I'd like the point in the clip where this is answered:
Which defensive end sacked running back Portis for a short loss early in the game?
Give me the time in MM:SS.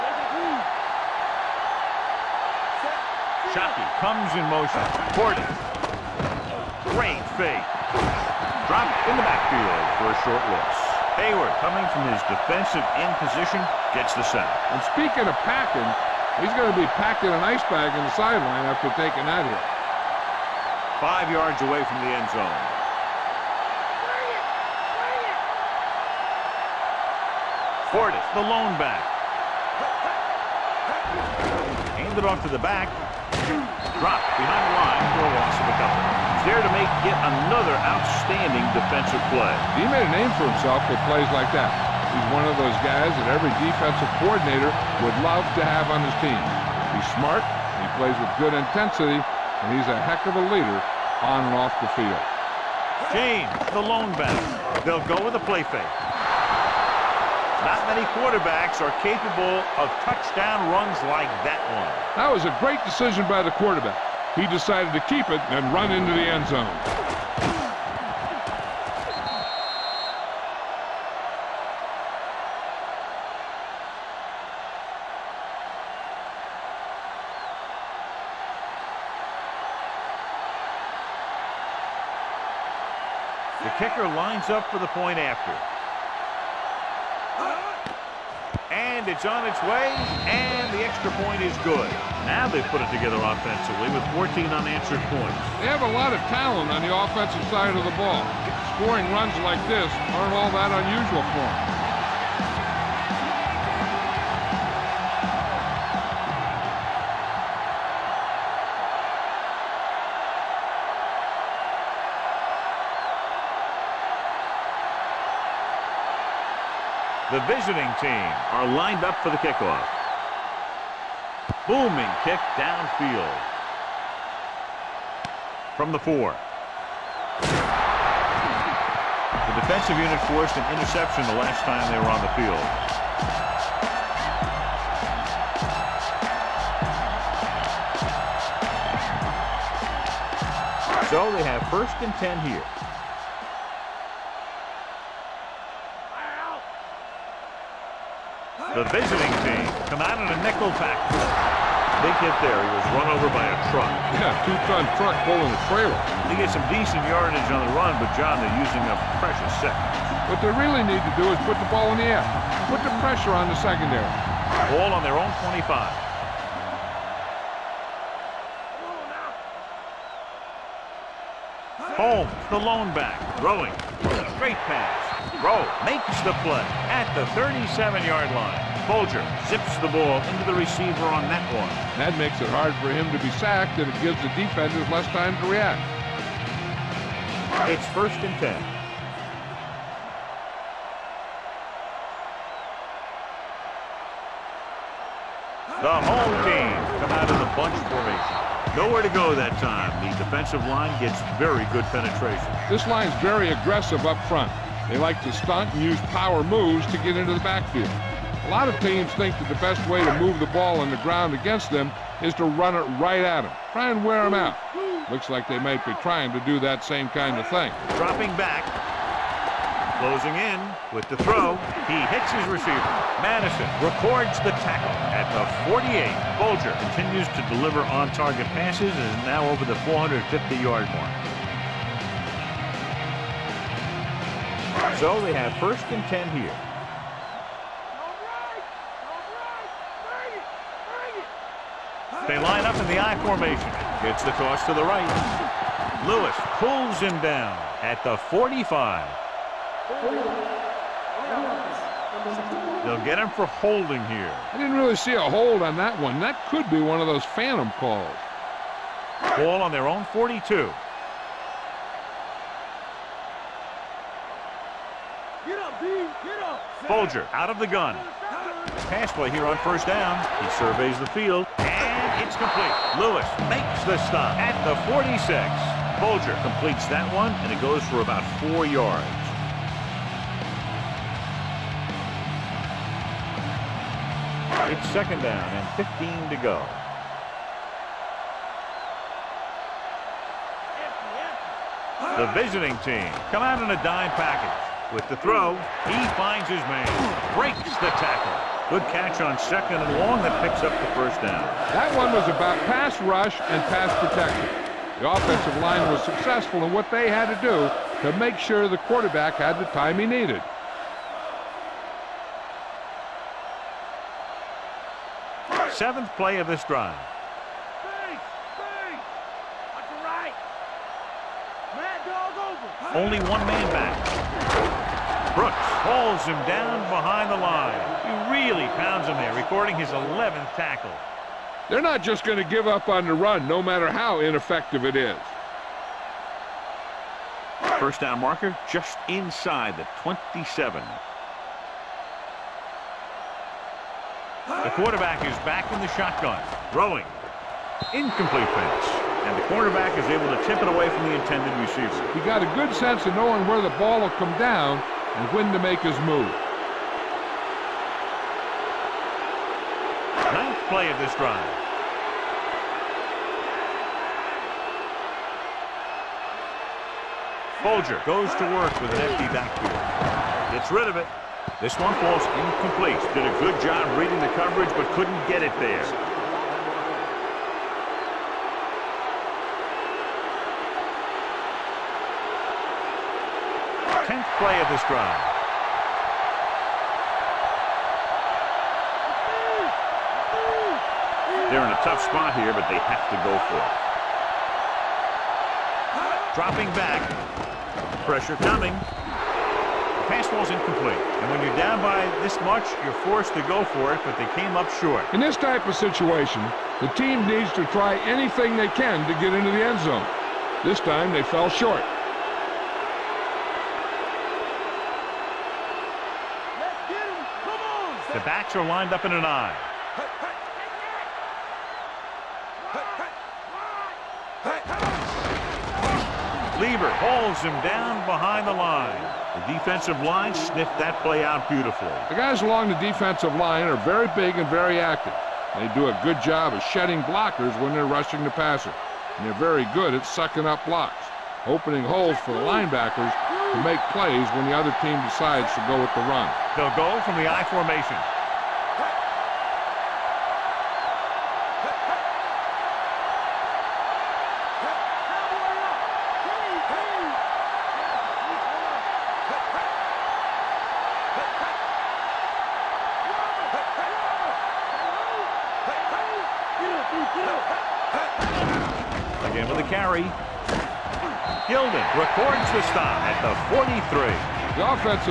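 00:11.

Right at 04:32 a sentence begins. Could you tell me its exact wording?
Lewis makes the stop at the 46.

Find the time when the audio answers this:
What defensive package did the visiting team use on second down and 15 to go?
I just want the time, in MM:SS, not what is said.
04:53.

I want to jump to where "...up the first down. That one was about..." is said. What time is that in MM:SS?
05:00.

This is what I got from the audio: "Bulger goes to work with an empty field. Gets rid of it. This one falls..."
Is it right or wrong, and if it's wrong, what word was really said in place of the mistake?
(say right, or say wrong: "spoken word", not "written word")
wrong: "backfield", not "field".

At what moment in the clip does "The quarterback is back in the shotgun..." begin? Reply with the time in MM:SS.
05:44.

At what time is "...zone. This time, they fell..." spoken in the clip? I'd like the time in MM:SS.
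06:49.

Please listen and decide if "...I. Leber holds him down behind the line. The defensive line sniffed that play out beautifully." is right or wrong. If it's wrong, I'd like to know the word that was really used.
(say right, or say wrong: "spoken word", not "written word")
right.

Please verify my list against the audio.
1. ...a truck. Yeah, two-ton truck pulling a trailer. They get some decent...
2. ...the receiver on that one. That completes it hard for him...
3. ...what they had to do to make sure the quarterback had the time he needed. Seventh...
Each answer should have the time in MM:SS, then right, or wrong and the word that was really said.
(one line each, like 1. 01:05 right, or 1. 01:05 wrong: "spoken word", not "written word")
1. 02:33 right
2. 03:00 wrong: "makes", not "completes"
3. 05:06 right.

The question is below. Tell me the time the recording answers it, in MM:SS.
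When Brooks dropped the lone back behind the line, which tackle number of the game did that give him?
05:29.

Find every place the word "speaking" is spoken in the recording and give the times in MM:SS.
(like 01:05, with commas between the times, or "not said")
00:14.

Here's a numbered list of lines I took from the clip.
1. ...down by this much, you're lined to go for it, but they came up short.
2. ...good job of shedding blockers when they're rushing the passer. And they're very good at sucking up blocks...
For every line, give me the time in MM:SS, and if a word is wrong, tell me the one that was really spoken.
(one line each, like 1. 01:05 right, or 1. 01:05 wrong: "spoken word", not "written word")
1. 06:41 wrong: "forced", not "lined"
2. 07:16 right.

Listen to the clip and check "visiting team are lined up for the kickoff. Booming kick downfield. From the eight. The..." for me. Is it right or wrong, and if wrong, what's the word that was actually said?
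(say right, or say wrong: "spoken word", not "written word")
wrong: "four", not "eight".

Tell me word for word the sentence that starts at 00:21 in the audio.
Five yards away from the end zone.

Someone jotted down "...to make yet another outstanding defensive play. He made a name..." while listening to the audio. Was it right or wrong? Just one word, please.
right.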